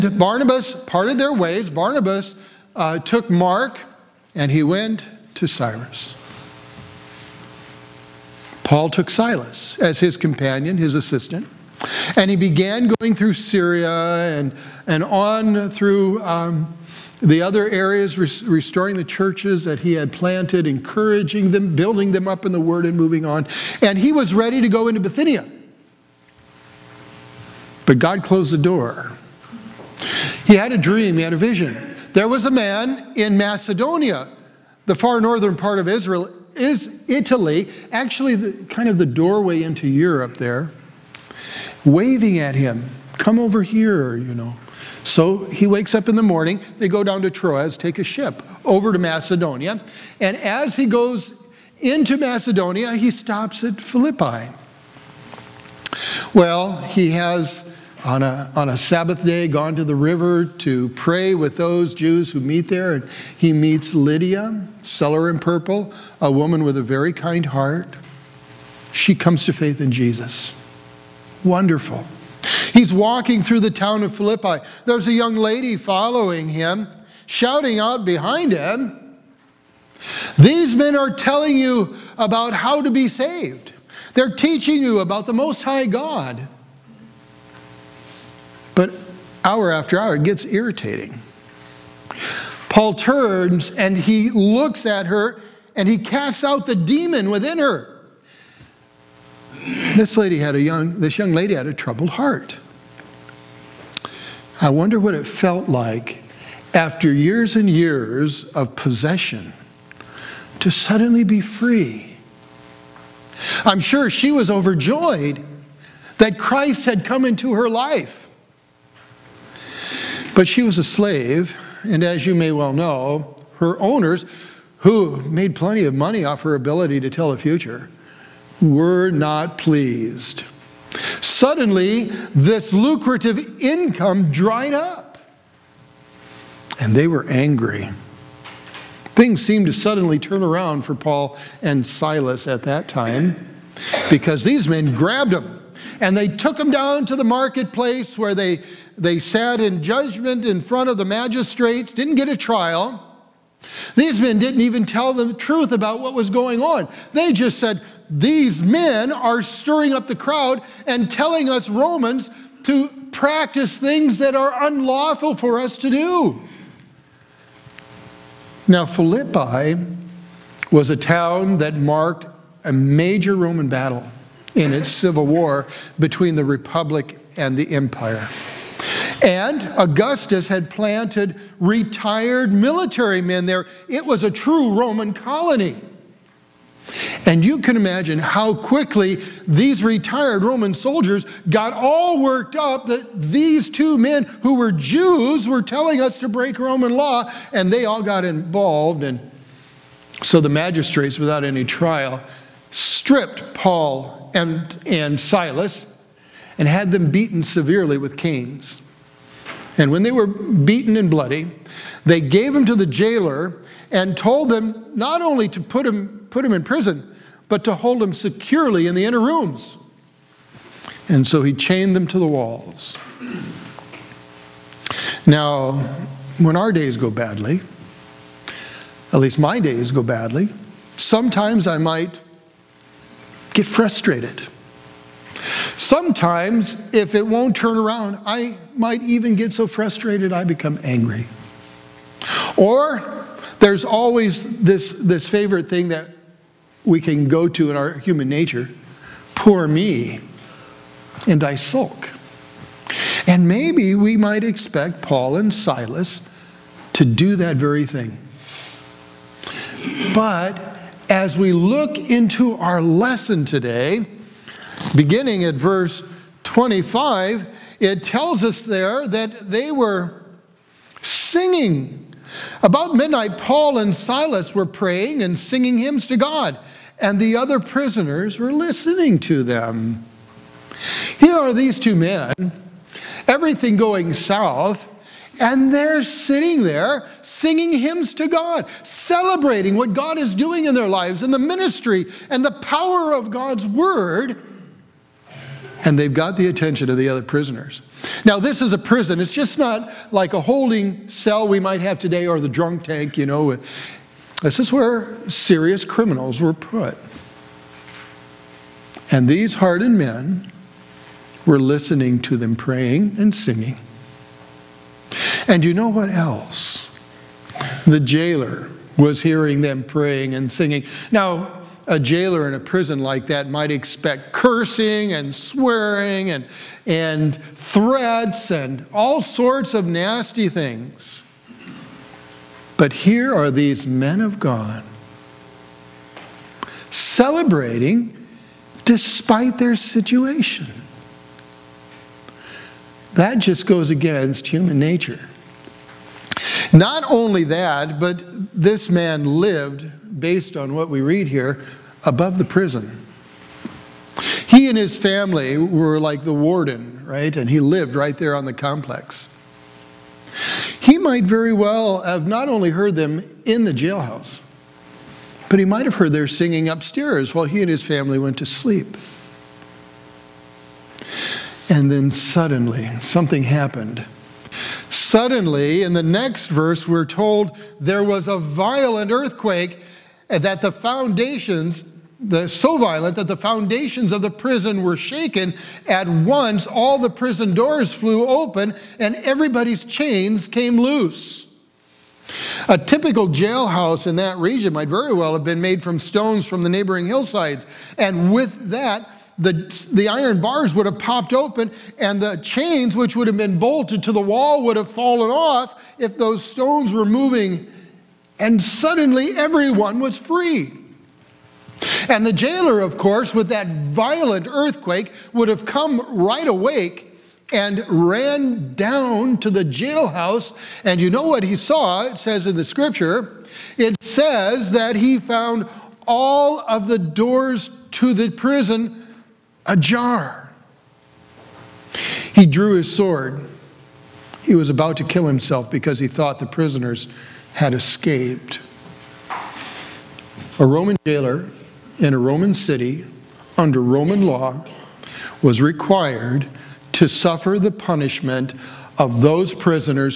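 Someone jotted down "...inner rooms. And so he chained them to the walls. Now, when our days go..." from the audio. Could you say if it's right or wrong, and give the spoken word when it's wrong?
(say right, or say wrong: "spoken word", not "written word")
right.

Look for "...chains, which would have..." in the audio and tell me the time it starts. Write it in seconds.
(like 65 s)
402 s.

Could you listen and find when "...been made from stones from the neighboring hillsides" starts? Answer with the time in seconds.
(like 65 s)
395 s.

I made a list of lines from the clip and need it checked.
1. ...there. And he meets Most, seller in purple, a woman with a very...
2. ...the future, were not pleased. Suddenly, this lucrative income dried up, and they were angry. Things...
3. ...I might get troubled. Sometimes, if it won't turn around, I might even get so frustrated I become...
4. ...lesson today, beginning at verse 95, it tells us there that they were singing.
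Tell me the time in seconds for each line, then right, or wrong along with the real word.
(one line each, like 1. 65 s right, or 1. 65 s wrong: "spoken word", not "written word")
1. 62 s wrong: "Lydia", not "Most"
2. 127 s right
3. 231 s wrong: "frustrated", not "troubled"
4. 262 s wrong: "25", not "95".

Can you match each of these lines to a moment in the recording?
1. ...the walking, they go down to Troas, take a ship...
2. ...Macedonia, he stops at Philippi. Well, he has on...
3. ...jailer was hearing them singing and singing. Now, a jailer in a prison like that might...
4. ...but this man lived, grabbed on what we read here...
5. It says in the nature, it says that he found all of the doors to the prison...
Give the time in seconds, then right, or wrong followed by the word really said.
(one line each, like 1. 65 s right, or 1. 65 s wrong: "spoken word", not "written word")
1. 46 s wrong: "morning", not "walking"
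2. 52 s right
3. 317 s wrong: "praying", not "singing"
4. 347 s wrong: "based", not "grabbed"
5. 422 s wrong: "scripture", not "nature".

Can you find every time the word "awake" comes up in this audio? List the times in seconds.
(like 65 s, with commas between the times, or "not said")
416 s.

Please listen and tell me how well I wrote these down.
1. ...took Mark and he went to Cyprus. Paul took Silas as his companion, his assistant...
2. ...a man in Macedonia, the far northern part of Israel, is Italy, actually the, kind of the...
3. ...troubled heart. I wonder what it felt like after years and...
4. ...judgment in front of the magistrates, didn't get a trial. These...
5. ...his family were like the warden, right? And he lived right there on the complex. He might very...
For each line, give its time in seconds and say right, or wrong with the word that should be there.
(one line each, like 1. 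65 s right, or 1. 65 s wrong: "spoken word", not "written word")
1. 2 s right
2. 32 s right
3. 101 s right
4. 149 s right
5. 354 s right.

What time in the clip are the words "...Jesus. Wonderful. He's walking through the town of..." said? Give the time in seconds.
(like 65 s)
69 s.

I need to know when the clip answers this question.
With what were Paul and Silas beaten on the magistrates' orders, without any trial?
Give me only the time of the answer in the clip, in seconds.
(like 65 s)
208 s.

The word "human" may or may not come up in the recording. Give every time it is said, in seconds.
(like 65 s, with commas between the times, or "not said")
247 s, 344 s.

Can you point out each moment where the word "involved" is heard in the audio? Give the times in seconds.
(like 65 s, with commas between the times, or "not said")
198 s.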